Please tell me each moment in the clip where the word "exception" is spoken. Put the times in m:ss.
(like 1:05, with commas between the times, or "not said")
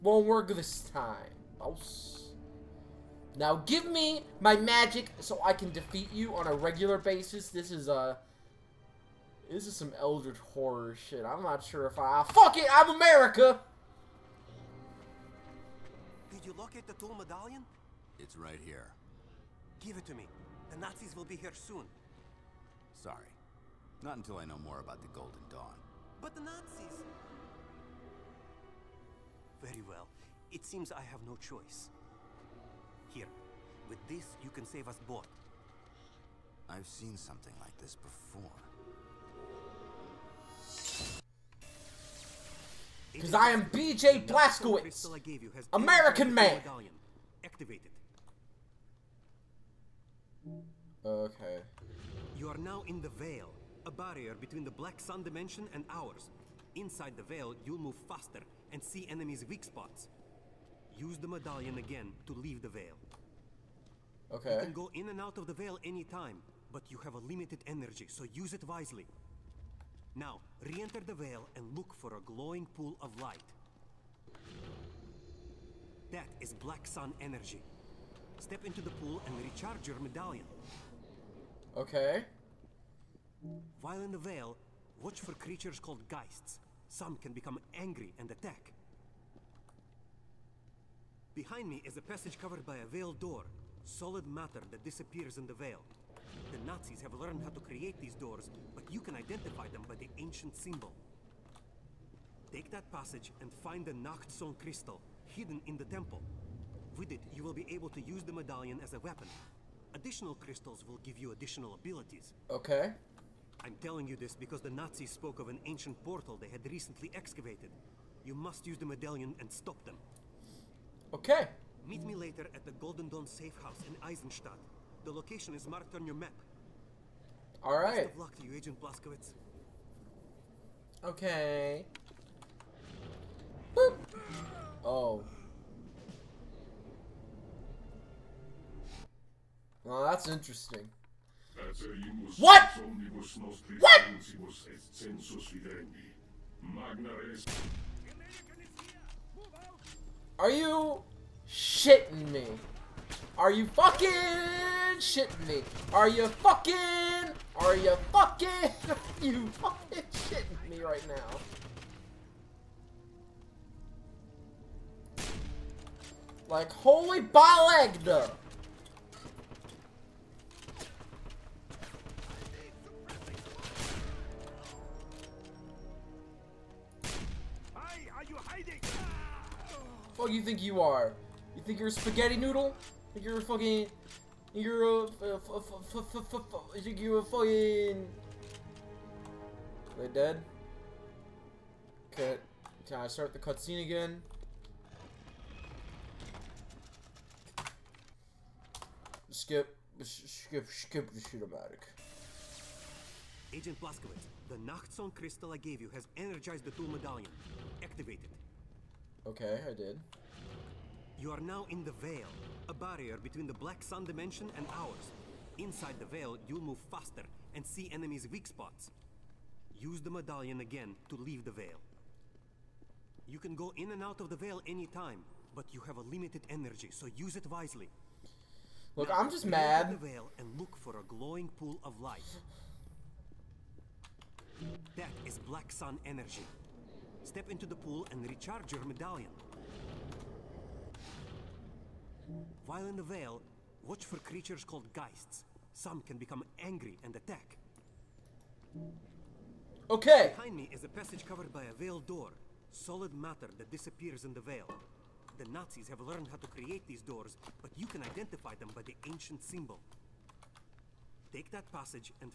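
not said.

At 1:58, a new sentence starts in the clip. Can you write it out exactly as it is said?
You must use the medallion and stop them.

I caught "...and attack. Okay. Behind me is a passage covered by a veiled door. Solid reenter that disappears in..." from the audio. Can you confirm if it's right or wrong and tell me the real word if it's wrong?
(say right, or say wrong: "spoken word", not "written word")
wrong: "matter", not "reenter".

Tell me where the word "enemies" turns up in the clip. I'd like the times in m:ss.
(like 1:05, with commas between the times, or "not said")
0:59, 3:37.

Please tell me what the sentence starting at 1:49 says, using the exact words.
Additional crystals will give you additional abilities.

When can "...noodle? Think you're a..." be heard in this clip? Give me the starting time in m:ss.
3:02.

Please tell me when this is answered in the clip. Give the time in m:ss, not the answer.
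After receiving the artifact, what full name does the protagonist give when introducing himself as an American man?
0:43.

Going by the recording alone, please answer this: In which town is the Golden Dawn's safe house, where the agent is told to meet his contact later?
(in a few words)
Eisenstadt.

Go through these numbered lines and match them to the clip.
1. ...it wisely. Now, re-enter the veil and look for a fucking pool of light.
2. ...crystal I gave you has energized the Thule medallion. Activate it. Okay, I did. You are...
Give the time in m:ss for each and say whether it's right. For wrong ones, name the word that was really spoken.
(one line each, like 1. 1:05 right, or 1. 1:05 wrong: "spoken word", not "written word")
1. 1:08 wrong: "glowing", not "fucking"
2. 3:25 right.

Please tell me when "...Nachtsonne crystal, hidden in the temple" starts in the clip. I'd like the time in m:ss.
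1:43.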